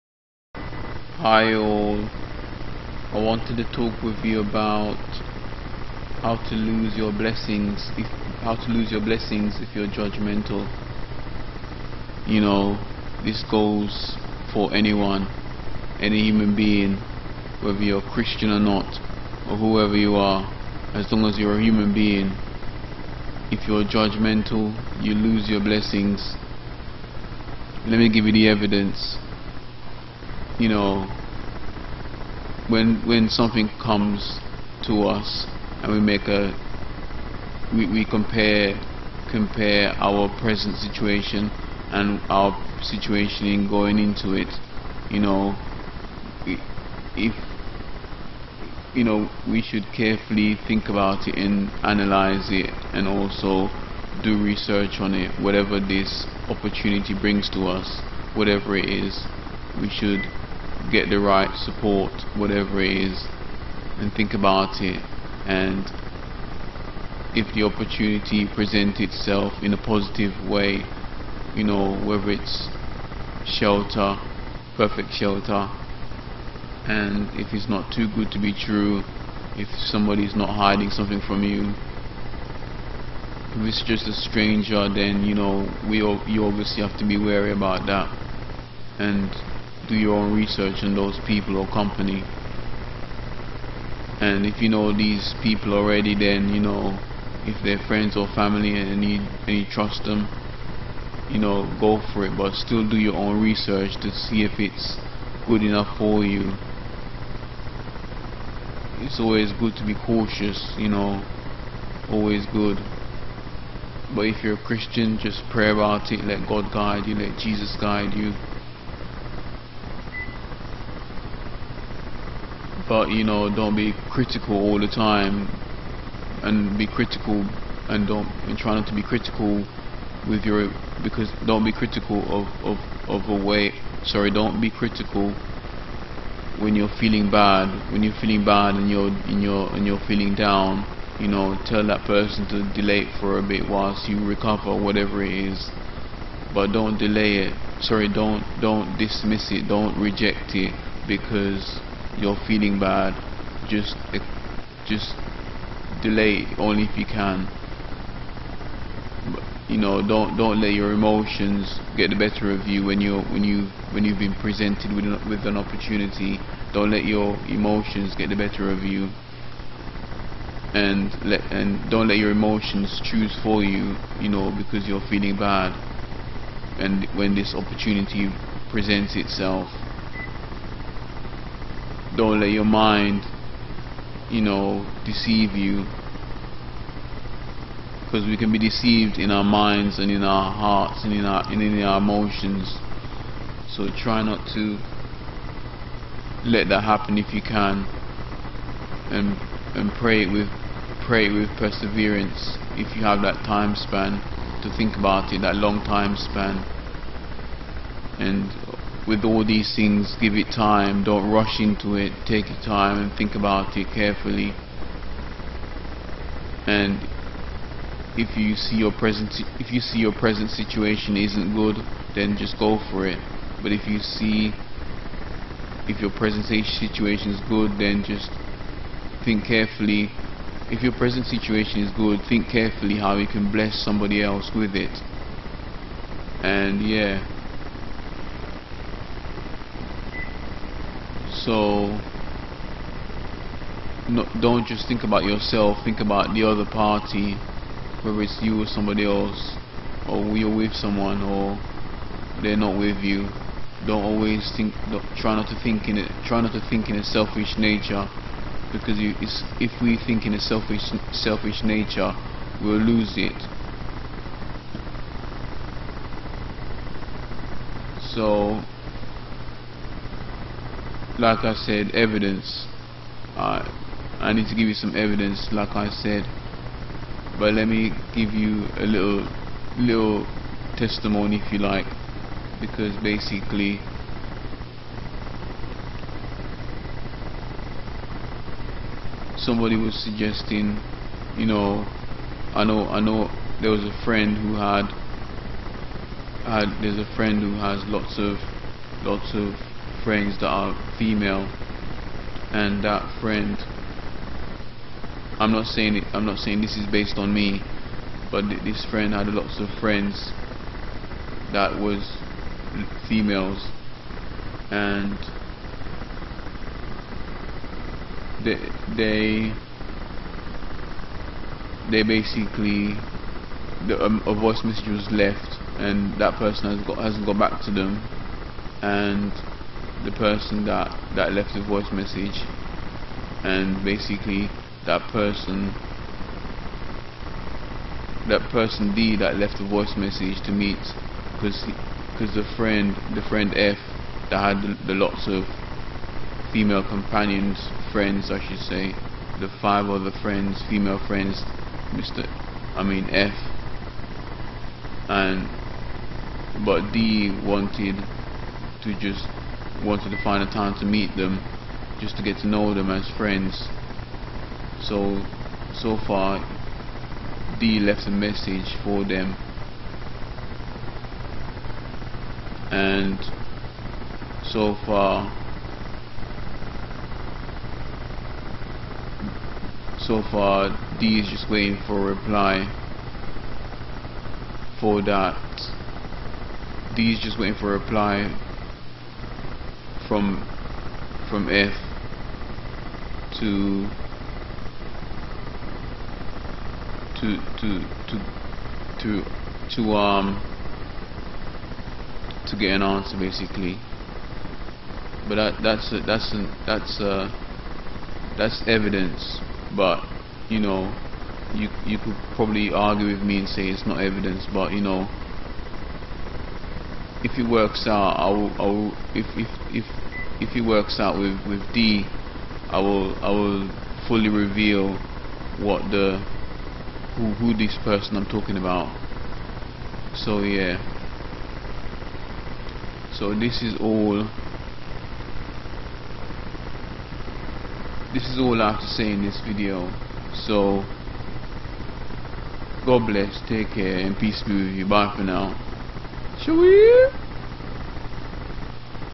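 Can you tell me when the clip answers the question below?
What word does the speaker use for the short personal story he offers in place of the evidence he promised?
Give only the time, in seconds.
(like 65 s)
280 s.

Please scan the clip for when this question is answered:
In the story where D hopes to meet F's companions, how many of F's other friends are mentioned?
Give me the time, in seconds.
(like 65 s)
349 s.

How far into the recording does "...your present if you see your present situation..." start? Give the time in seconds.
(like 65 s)
218 s.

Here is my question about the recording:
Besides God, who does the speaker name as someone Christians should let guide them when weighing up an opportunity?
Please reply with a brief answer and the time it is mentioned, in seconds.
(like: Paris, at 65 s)
Jesus, at 117 s.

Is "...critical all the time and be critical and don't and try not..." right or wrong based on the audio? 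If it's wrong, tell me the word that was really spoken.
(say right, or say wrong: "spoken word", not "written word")
right.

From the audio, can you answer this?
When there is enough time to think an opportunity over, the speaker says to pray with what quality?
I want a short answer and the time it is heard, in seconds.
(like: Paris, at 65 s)
perseverance, at 201 s.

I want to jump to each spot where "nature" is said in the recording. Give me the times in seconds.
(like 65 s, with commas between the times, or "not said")
257 s, 261 s.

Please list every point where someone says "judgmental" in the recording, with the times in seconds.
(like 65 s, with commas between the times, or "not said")
9 s, 23 s.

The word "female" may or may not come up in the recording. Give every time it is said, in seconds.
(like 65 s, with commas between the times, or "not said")
300 s, 313 s, 346 s, 350 s.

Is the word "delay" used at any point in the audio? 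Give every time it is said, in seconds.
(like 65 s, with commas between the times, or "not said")
142 s, 146 s, 156 s.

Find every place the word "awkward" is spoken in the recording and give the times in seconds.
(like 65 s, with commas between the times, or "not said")
not said.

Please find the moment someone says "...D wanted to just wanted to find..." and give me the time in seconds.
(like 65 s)
356 s.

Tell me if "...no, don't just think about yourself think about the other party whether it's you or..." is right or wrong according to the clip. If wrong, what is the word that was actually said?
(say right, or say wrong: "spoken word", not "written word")
right.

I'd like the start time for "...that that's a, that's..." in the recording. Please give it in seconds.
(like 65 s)
405 s.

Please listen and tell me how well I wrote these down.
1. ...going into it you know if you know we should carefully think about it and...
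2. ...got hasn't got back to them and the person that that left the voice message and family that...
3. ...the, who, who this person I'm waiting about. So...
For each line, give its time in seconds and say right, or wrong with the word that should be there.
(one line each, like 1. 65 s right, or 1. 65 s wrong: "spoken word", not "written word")
1. 43 s right
2. 326 s wrong: "basically", not "family"
3. 425 s wrong: "talking", not "waiting".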